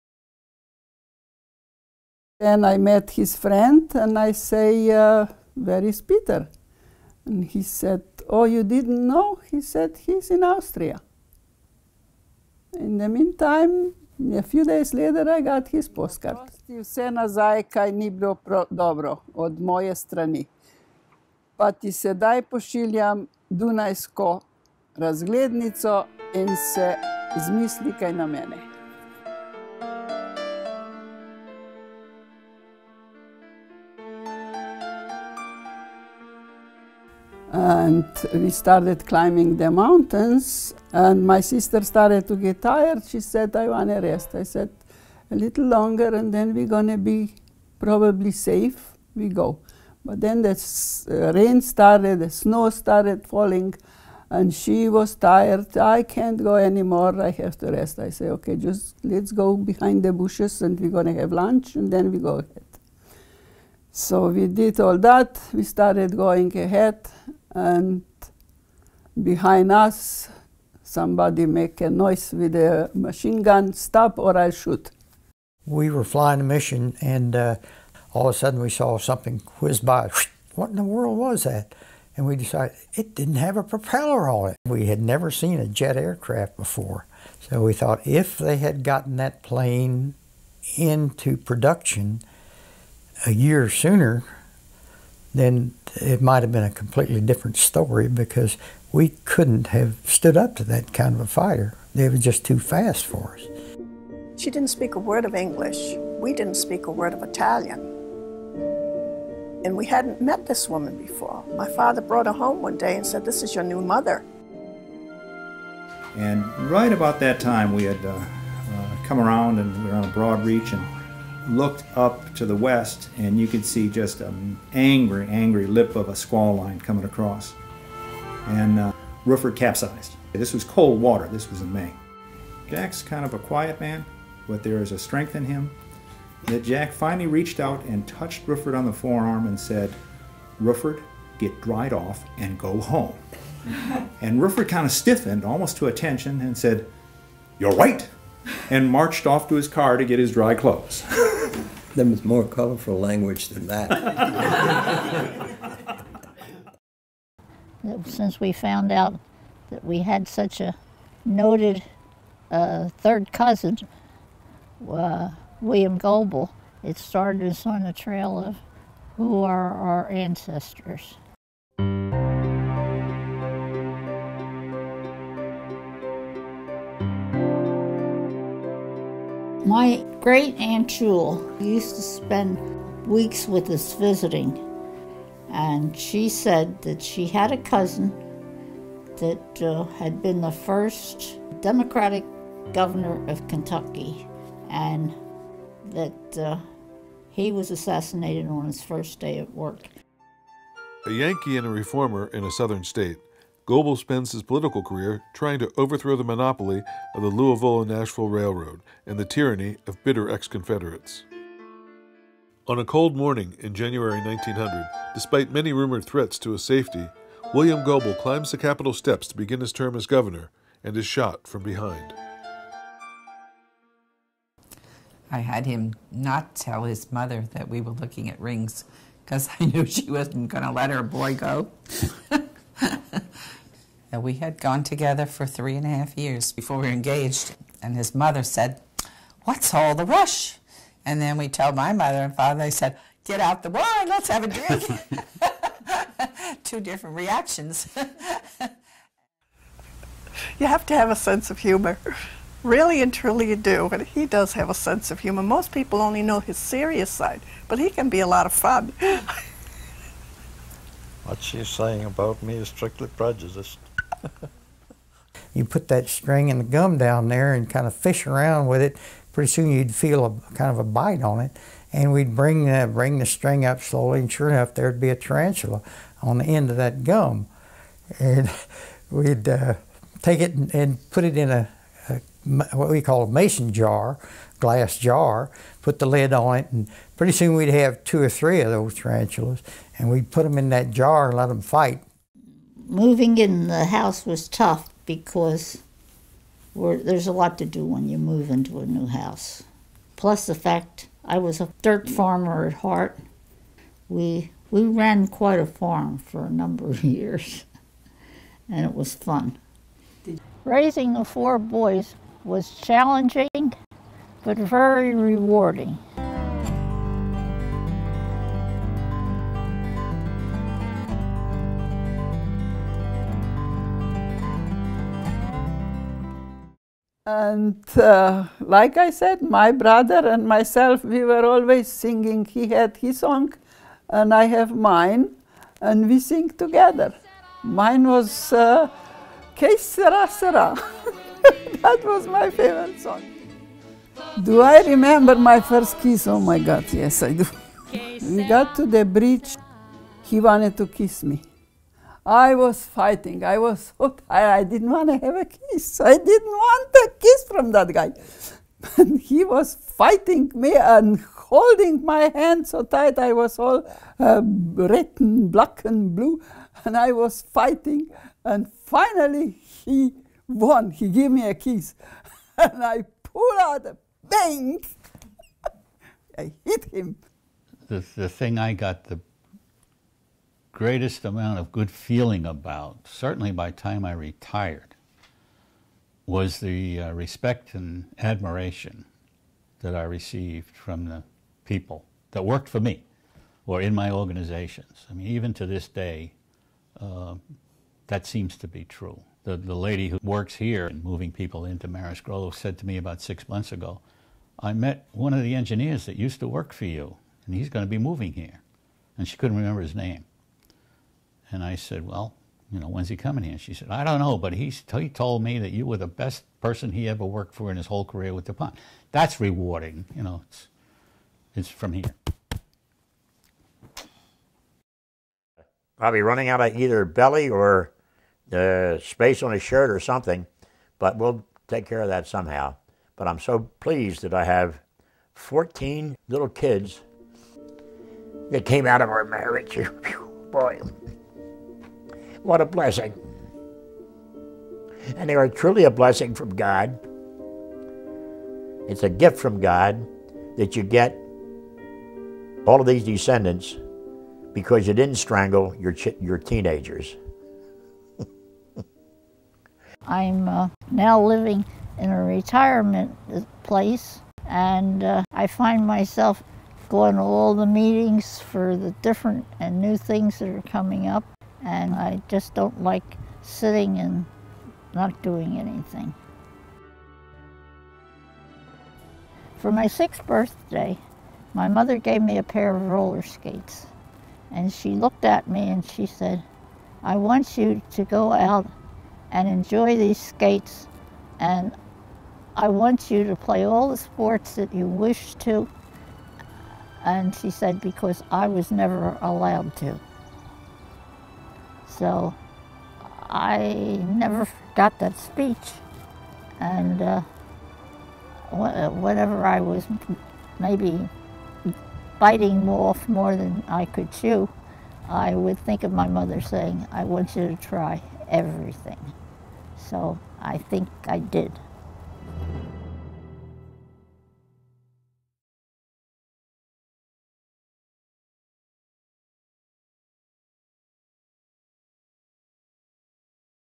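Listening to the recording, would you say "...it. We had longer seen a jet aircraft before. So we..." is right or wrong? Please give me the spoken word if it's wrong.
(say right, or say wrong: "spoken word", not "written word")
wrong: "never", not "longer".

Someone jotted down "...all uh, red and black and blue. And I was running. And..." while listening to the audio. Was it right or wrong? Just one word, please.
wrong.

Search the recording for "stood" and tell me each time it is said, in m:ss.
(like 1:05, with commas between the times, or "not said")
1:40.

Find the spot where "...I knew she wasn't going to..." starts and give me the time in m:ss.
3:49.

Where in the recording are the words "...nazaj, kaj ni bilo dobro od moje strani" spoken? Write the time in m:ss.
0:17.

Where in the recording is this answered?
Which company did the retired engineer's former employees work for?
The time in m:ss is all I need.
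6:58.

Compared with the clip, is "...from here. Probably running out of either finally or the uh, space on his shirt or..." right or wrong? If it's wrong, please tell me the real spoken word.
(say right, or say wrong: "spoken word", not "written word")
wrong: "belly", not "finally".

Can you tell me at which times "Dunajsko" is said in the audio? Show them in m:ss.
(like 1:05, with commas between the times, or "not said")
0:23.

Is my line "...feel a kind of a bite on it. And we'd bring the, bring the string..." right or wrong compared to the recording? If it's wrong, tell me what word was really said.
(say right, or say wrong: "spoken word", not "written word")
right.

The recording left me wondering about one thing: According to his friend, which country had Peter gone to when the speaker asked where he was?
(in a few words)
Austria.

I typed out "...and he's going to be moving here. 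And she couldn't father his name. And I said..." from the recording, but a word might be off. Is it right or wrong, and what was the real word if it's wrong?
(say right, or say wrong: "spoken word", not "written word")
wrong: "remember", not "father".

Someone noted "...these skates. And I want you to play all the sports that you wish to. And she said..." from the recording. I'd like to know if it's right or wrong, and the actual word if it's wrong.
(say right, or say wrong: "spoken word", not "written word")
right.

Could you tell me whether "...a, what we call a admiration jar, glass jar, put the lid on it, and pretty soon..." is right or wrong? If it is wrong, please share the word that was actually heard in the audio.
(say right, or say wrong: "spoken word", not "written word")
wrong: "mason", not "admiration".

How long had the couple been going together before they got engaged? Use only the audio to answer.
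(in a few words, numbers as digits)
3 and a half years.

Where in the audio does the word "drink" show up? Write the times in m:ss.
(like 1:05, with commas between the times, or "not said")
4:04.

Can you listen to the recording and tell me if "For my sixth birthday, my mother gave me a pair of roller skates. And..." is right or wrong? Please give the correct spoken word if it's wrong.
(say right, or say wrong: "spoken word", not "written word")
right.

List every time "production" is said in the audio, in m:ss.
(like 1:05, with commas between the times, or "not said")
1:31.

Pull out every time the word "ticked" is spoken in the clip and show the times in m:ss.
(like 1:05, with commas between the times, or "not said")
not said.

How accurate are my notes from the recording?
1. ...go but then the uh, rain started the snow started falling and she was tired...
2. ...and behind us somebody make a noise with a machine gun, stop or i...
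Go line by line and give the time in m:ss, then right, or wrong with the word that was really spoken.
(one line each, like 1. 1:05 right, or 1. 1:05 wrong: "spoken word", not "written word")
1. 0:49 right
2. 1:07 right.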